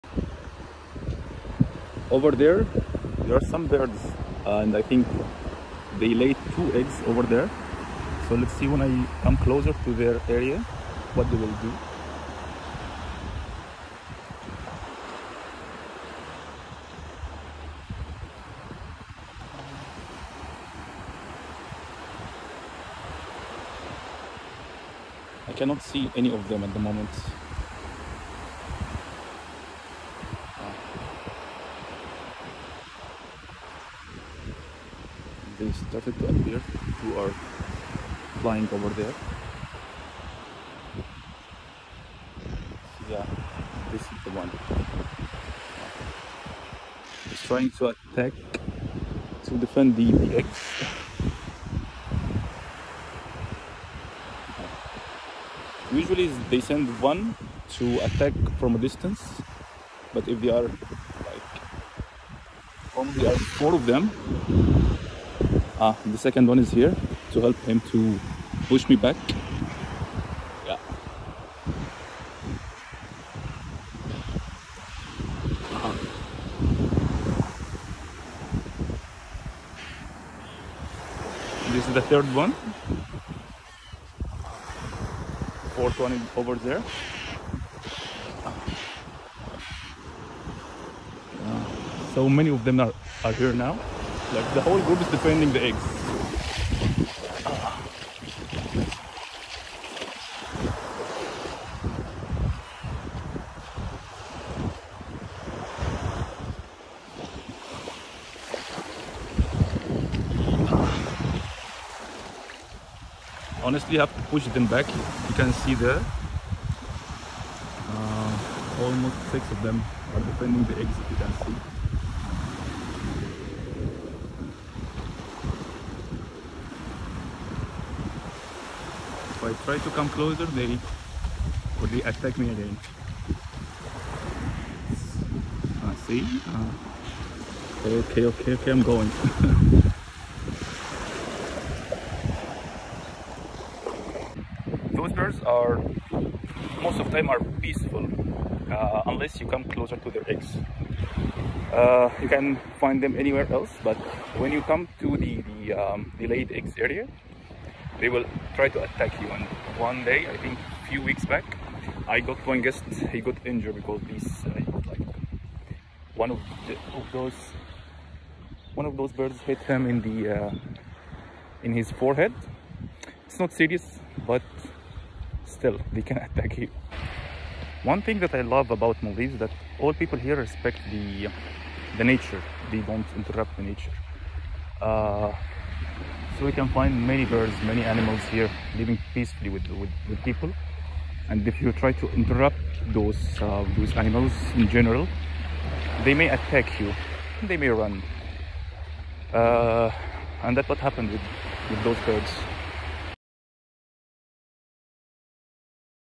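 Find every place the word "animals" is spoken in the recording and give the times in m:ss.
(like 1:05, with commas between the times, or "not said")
3:07, 3:13.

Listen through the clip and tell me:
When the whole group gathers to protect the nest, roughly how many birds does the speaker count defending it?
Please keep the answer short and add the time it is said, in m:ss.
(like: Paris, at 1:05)
6, at 1:59.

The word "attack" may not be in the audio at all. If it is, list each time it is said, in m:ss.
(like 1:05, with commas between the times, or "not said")
0:47, 0:57, 2:12, 2:38, 2:56, 3:16.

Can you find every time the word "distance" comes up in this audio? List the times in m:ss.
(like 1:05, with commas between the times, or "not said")
0:58.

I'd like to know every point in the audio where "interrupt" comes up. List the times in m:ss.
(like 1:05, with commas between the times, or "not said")
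3:03, 3:12.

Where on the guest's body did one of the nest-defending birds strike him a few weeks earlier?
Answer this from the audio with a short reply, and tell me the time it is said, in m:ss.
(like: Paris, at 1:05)
Forehead, at 2:51.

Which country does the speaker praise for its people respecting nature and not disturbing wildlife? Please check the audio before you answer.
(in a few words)
Maldives.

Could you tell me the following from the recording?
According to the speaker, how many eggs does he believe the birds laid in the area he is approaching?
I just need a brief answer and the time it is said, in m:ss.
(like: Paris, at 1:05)
2, at 0:06.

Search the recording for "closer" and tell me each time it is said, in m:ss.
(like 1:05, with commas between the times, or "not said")
0:09, 2:10, 2:29.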